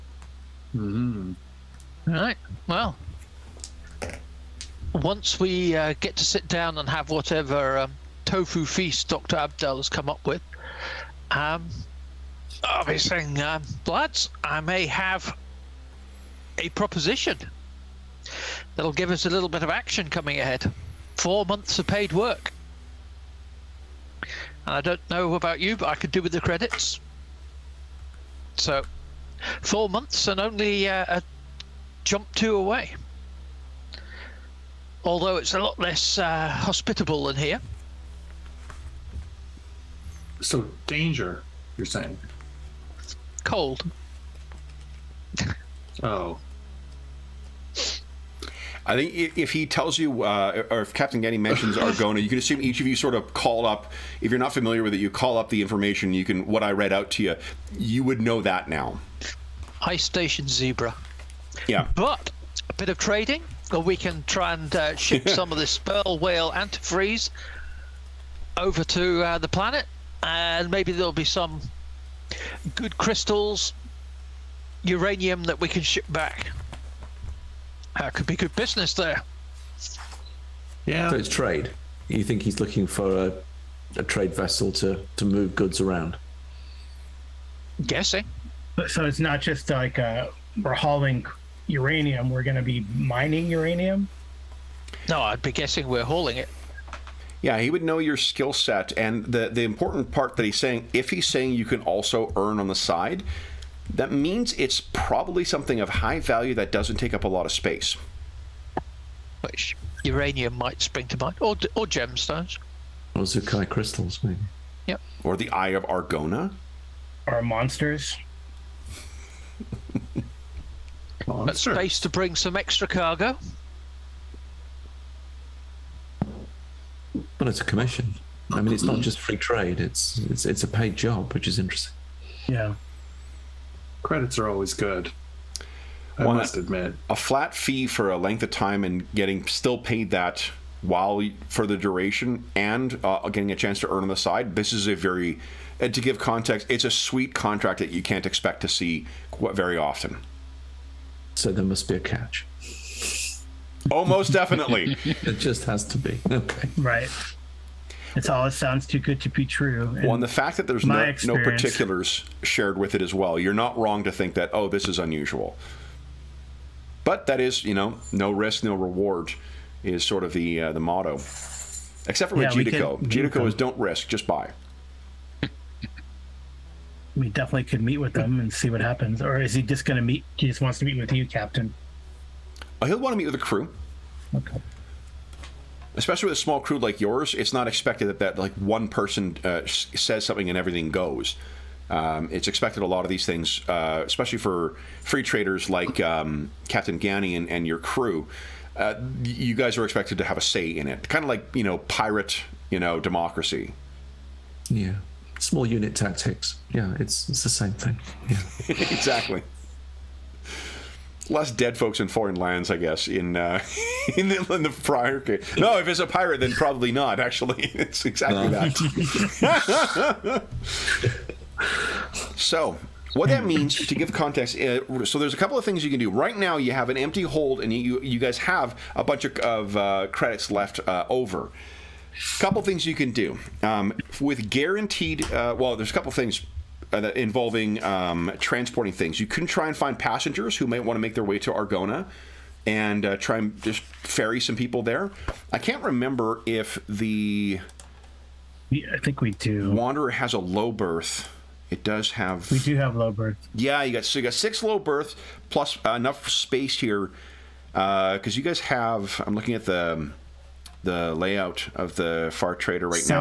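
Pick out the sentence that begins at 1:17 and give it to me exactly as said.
That could be good business there.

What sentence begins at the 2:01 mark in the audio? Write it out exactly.
space to bring some extra cargo.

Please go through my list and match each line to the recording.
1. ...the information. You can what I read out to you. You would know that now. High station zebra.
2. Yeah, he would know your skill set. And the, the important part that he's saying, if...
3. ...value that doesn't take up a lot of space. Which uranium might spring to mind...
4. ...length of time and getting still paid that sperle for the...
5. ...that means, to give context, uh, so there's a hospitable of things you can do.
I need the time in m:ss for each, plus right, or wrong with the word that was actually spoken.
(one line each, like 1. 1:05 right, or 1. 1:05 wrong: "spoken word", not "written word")
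1. 0:55 right
2. 1:37 right
3. 1:46 right
4. 2:18 wrong: "while", not "sperle"
5. 3:43 wrong: "couple", not "hospitable".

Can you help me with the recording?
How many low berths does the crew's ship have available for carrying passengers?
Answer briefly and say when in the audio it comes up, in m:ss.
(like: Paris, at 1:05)
6, at 4:14.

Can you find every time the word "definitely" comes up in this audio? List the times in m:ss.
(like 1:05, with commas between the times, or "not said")
2:34, 2:57.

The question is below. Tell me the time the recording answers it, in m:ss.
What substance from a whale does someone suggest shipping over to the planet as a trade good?
1:06.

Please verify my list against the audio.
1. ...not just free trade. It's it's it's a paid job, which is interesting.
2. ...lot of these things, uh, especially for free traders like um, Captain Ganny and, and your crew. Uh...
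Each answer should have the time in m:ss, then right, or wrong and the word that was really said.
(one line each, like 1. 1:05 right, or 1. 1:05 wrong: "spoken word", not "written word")
1. 2:08 right
2. 3:12 right.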